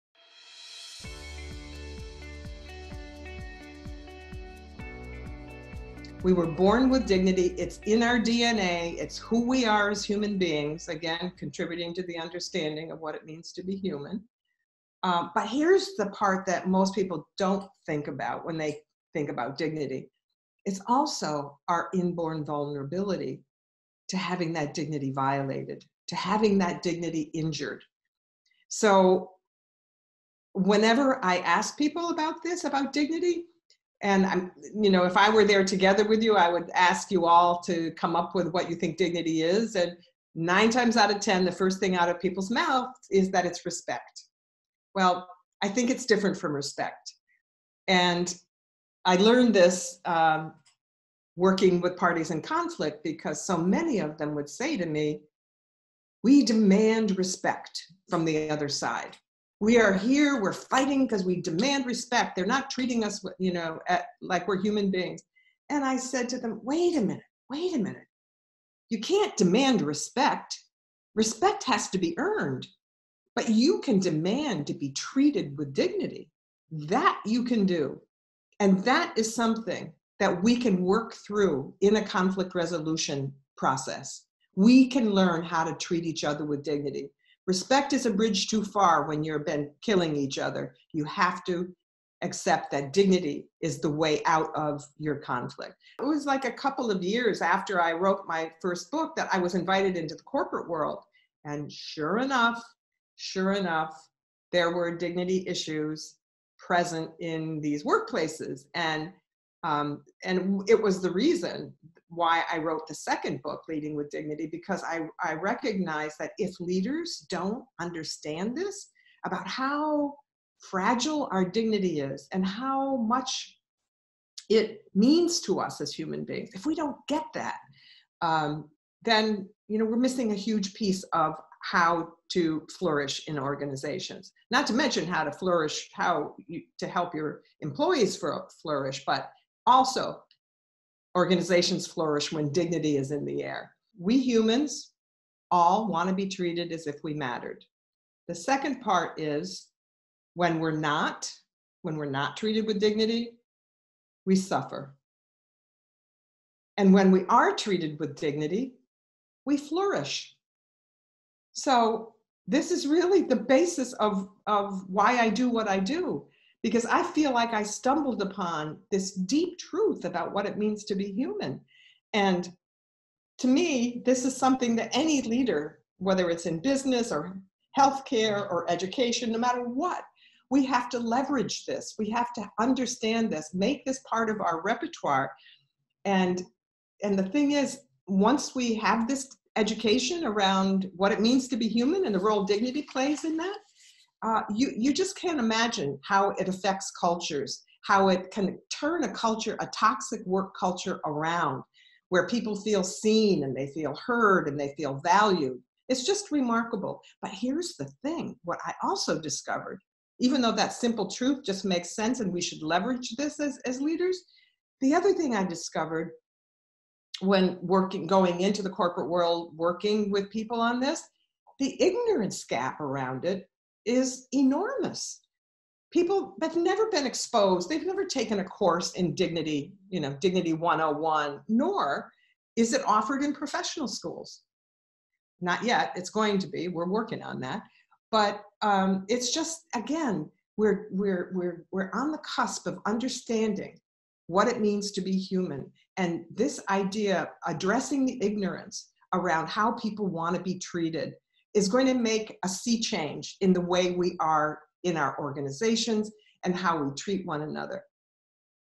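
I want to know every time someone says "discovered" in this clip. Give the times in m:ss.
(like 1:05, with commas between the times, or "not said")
3:29, 3:35.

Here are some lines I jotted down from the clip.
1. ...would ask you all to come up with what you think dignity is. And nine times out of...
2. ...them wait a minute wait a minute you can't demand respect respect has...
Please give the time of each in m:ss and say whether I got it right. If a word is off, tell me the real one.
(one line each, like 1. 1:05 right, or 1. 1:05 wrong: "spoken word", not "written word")
1. 0:36 right
2. 1:06 right.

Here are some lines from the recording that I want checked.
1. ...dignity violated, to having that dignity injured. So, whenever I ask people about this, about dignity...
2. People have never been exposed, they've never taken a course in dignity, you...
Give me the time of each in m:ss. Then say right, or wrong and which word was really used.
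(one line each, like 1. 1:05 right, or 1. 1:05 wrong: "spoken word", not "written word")
1. 0:24 right
2. 3:45 right.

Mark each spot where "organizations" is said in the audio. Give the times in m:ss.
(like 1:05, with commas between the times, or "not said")
2:13, 2:21, 4:15.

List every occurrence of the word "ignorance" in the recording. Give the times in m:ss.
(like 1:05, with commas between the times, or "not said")
3:41, 4:08.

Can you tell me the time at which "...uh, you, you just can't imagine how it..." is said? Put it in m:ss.
3:14.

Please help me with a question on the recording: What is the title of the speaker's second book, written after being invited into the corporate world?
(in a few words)
Leading with Dignity.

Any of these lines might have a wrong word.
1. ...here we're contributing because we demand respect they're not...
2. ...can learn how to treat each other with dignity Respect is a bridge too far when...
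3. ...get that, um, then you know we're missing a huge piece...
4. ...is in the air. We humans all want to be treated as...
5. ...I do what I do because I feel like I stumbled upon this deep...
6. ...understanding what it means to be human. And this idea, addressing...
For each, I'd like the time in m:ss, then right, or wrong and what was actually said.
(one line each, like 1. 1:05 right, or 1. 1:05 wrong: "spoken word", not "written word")
1. 0:59 wrong: "fighting", not "contributing"
2. 1:24 right
3. 2:07 right
4. 2:22 right
5. 2:45 right
6. 4:02 right.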